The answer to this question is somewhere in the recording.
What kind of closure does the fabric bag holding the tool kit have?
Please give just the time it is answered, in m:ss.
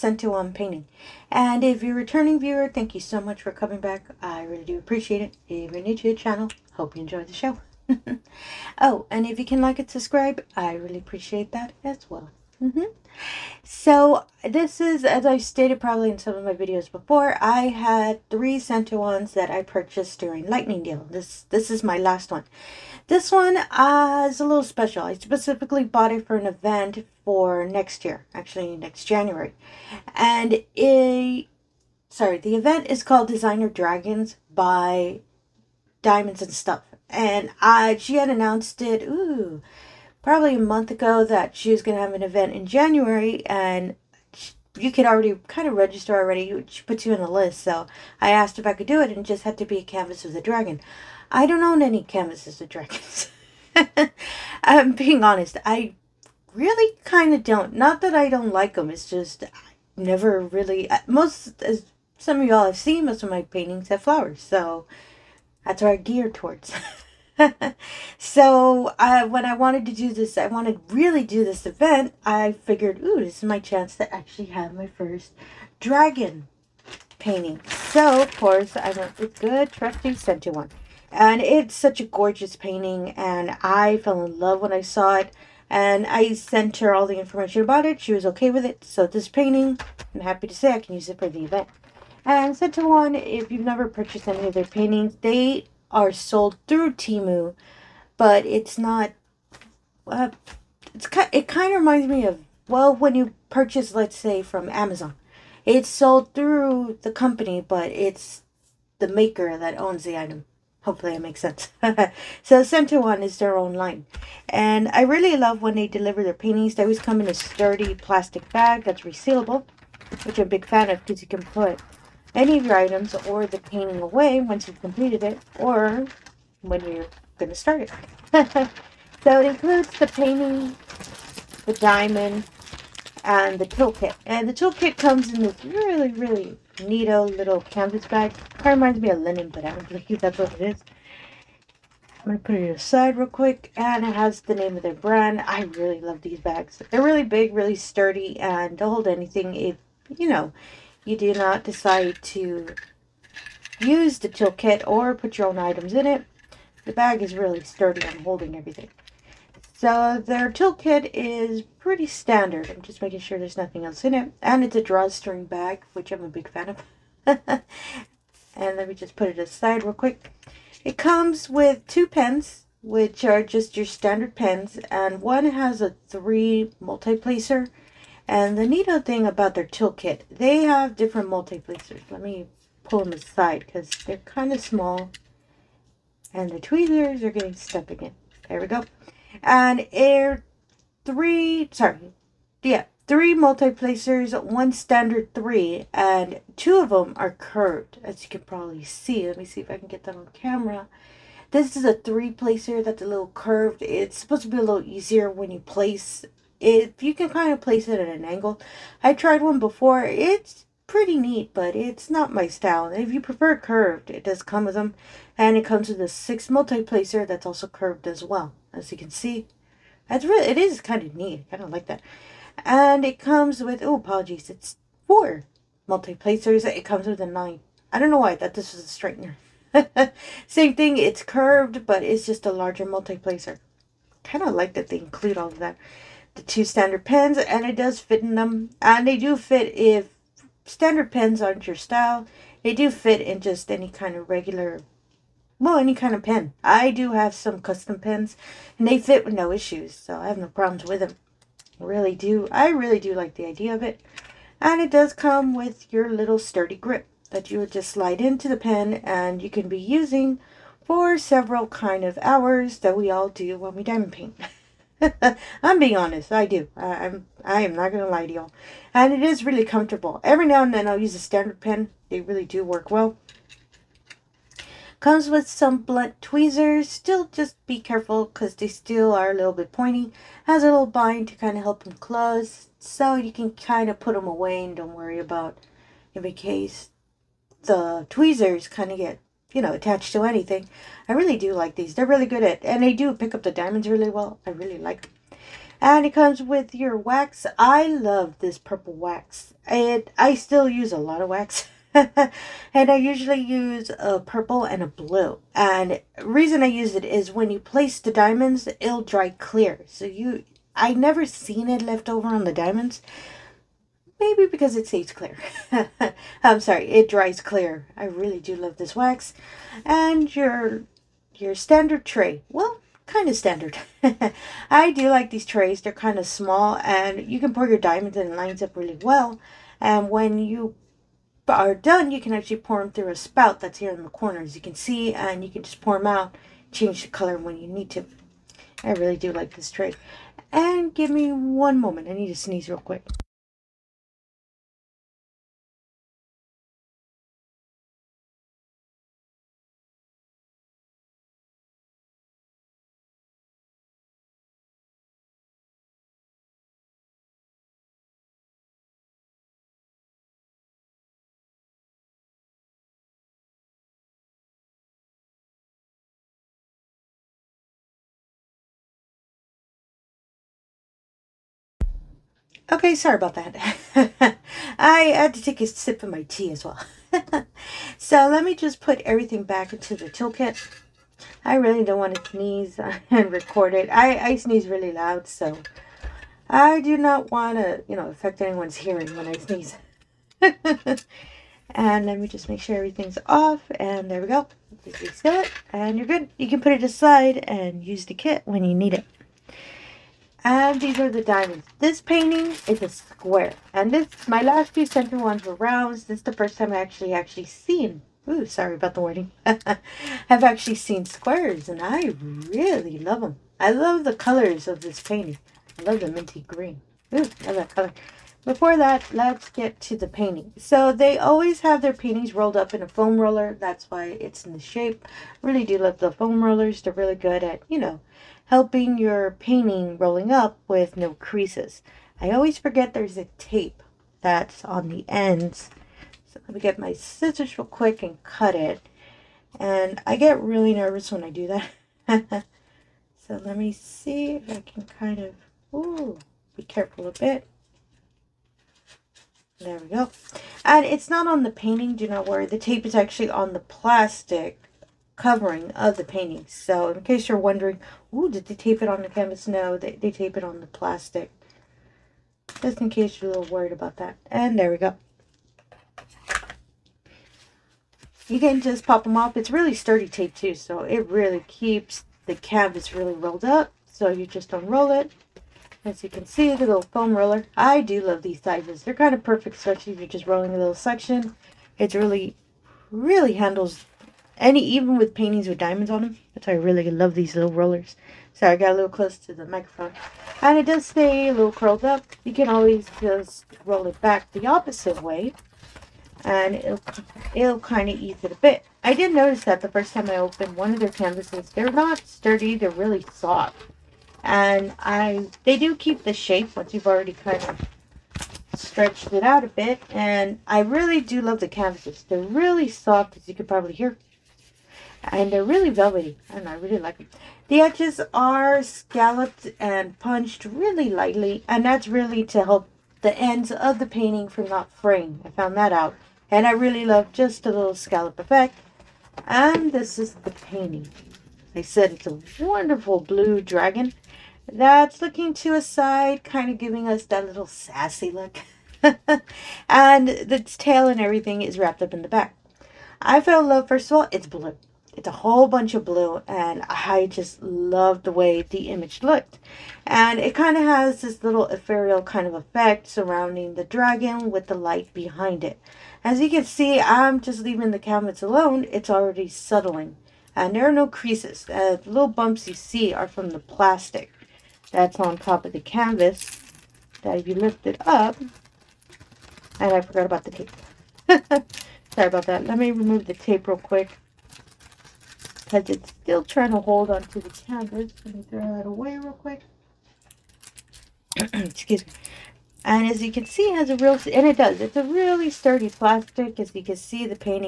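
2:44.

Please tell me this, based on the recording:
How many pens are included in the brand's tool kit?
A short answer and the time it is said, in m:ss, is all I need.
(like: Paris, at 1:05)
2, at 2:51.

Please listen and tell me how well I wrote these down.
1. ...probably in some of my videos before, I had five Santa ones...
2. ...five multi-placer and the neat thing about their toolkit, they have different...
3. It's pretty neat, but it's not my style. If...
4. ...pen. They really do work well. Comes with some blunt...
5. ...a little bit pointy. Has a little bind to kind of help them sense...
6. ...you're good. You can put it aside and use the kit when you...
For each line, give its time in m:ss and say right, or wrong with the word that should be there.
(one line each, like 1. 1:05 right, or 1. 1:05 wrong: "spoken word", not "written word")
1. 0:15 wrong: "three", not "five"
2. 2:56 wrong: "three", not "five"
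3. 3:30 right
4. 4:31 right
5. 4:39 wrong: "close", not "sense"
6. 6:35 right.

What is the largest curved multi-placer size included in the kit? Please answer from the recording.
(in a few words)
9.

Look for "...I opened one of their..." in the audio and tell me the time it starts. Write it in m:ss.
8:20.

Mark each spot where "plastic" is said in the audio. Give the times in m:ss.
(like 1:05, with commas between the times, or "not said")
1:57, 7:33, 7:40, 9:23, 9:45.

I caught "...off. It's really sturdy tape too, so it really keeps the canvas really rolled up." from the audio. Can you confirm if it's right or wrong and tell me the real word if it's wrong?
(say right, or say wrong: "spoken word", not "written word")
right.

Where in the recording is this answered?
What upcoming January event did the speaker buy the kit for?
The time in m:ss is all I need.
0:33.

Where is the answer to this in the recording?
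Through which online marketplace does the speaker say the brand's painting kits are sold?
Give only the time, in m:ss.
1:36.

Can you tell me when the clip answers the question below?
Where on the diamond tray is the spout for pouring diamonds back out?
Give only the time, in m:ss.
5:33.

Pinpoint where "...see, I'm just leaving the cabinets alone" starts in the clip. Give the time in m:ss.
9:16.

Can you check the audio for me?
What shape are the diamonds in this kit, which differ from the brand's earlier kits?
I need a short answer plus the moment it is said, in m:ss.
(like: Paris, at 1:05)
Square, at 6:42.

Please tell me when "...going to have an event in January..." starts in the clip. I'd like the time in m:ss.
0:41.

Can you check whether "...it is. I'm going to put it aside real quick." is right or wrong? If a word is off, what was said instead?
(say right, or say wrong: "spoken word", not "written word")
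right.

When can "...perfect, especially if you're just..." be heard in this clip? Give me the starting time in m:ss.
7:59.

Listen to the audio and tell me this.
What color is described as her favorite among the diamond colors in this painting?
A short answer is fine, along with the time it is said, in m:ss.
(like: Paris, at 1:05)
Minty green, at 6:56.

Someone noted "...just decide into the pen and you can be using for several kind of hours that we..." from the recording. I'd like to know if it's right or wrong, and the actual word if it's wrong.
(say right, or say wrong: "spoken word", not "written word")
wrong: "slide", not "decide".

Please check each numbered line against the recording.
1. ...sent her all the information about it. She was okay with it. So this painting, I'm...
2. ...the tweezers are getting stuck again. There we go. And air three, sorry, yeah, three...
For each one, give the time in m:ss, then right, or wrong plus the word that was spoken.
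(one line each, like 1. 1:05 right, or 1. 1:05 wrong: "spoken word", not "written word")
1. 1:26 right
2. 3:06 right.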